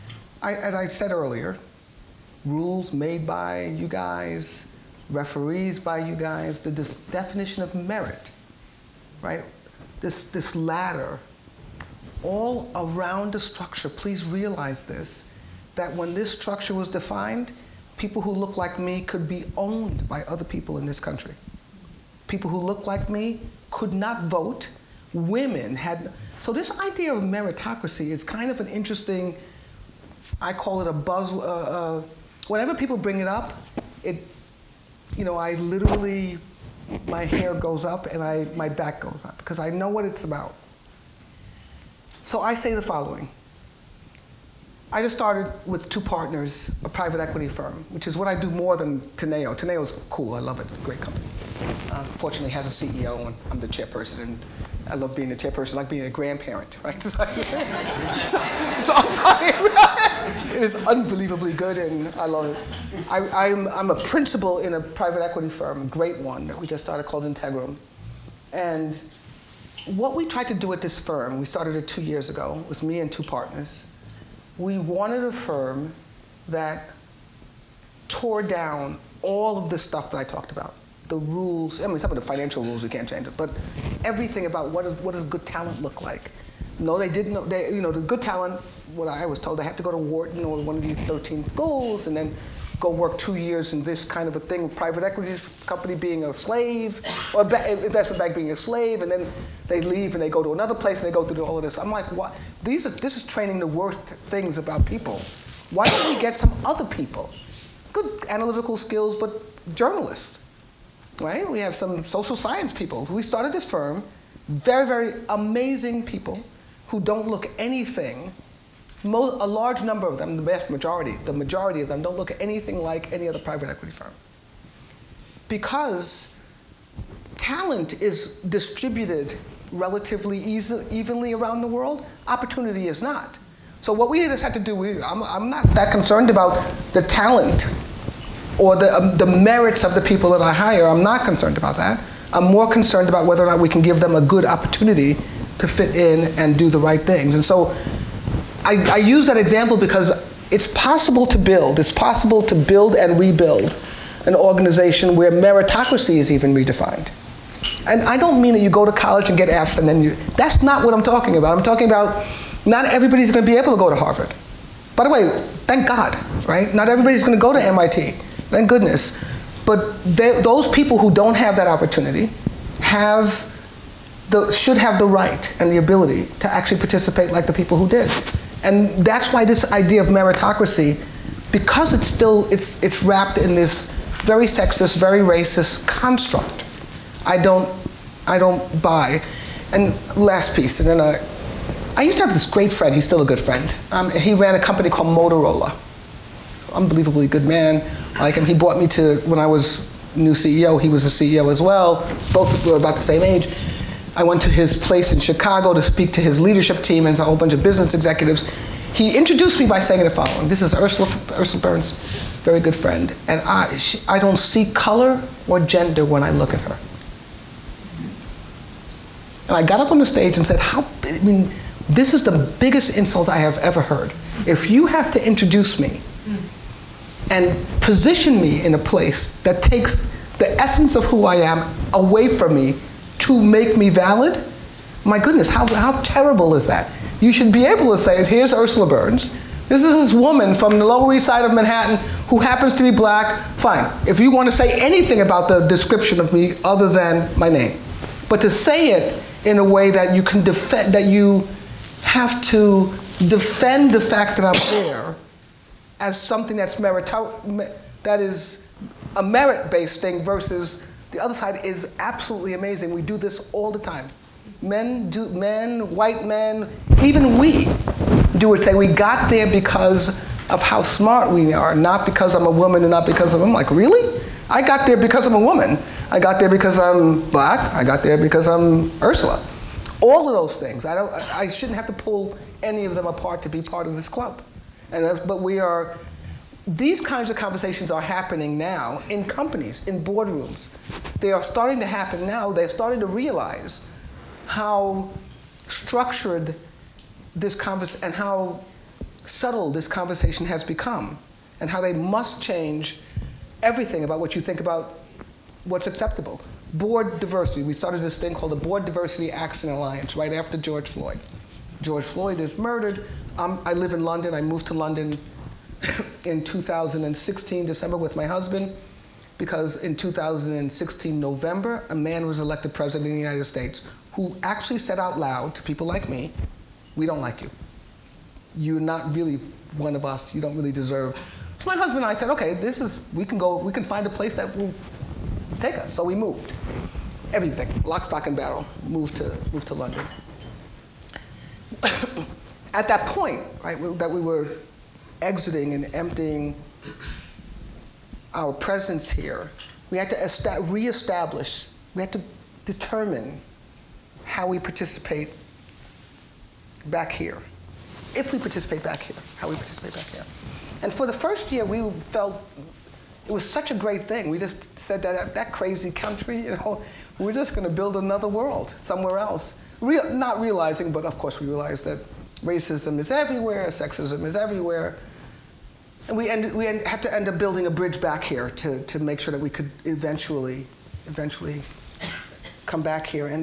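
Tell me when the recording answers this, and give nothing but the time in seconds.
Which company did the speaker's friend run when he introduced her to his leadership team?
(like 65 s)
195 s.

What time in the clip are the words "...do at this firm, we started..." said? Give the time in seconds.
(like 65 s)
70 s.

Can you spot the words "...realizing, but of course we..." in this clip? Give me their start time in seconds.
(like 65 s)
370 s.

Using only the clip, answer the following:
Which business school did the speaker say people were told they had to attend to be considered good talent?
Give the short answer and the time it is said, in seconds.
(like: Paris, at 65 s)
Wharton, at 89 s.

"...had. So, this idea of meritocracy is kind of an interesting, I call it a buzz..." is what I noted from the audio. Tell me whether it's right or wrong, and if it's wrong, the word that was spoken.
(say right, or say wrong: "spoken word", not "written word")
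right.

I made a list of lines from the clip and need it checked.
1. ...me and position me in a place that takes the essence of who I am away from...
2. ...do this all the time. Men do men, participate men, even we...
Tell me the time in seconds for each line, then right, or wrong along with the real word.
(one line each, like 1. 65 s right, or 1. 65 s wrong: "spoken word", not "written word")
1. 225 s right
2. 263 s wrong: "white", not "participate".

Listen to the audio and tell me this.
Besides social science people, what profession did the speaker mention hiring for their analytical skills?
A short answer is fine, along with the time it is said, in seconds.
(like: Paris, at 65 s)
Journalists, at 109 s.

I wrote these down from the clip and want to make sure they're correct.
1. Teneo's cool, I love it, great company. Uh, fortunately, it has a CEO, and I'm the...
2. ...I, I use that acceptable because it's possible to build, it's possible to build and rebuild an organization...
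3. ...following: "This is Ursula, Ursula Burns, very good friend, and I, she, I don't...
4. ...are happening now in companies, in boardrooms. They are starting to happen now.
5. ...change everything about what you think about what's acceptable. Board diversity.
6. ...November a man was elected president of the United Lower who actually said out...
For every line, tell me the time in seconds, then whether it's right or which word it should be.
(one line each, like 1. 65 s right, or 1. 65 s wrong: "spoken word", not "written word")
1. 49 s right
2. 148 s wrong: "example", not "acceptable"
3. 210 s right
4. 287 s right
5. 302 s right
6. 321 s wrong: "States", not "Lower".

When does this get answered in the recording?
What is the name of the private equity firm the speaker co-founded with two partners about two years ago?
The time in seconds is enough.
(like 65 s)
67 s.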